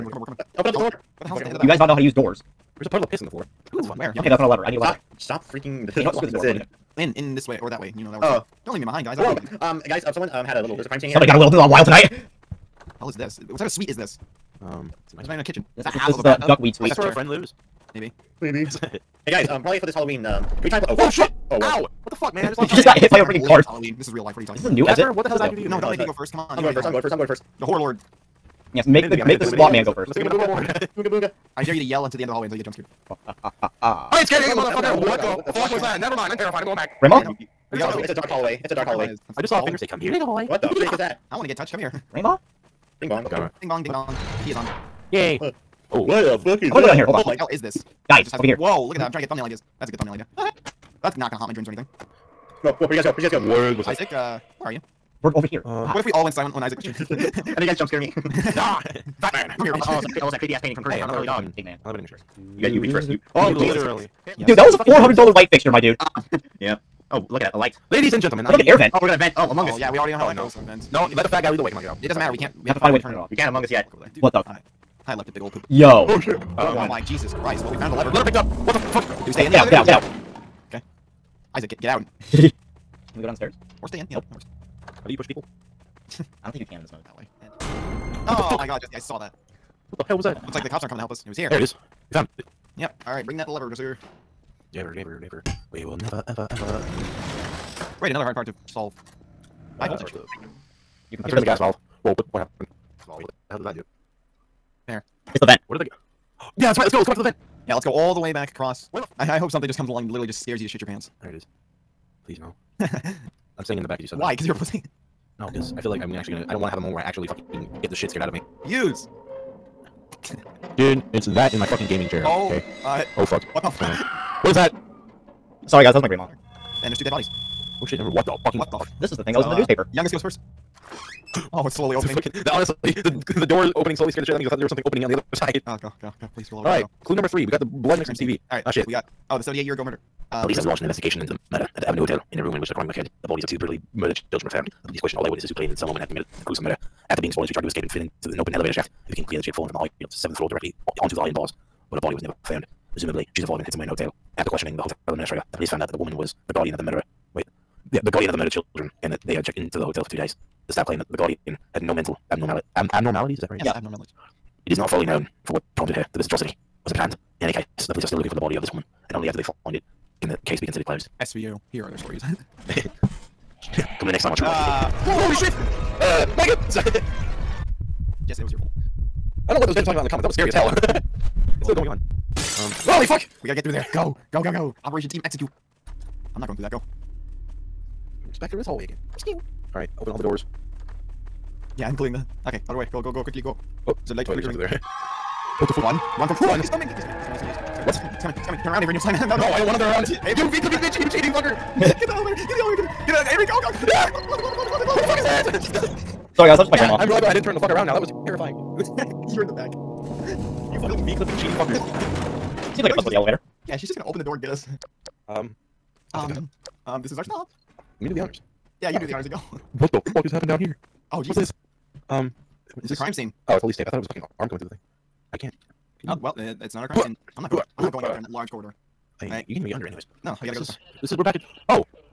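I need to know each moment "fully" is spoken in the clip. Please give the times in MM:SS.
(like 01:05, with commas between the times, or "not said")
02:44.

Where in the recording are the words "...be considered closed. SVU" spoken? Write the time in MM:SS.
02:50.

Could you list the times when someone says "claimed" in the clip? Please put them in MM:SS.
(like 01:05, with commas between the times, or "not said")
02:25, 02:40.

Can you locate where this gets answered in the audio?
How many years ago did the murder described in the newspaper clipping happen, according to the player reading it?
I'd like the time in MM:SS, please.
02:19.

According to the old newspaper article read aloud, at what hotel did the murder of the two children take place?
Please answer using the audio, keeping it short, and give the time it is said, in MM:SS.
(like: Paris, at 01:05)
Avenue Hotel, at 02:21.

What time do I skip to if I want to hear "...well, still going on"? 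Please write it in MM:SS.
03:01.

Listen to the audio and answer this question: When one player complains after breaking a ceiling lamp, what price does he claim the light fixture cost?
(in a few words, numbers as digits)
$400.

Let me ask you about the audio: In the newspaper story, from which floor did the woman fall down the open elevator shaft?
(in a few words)
seventh floor.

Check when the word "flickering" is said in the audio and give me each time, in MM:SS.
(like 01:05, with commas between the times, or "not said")
03:14.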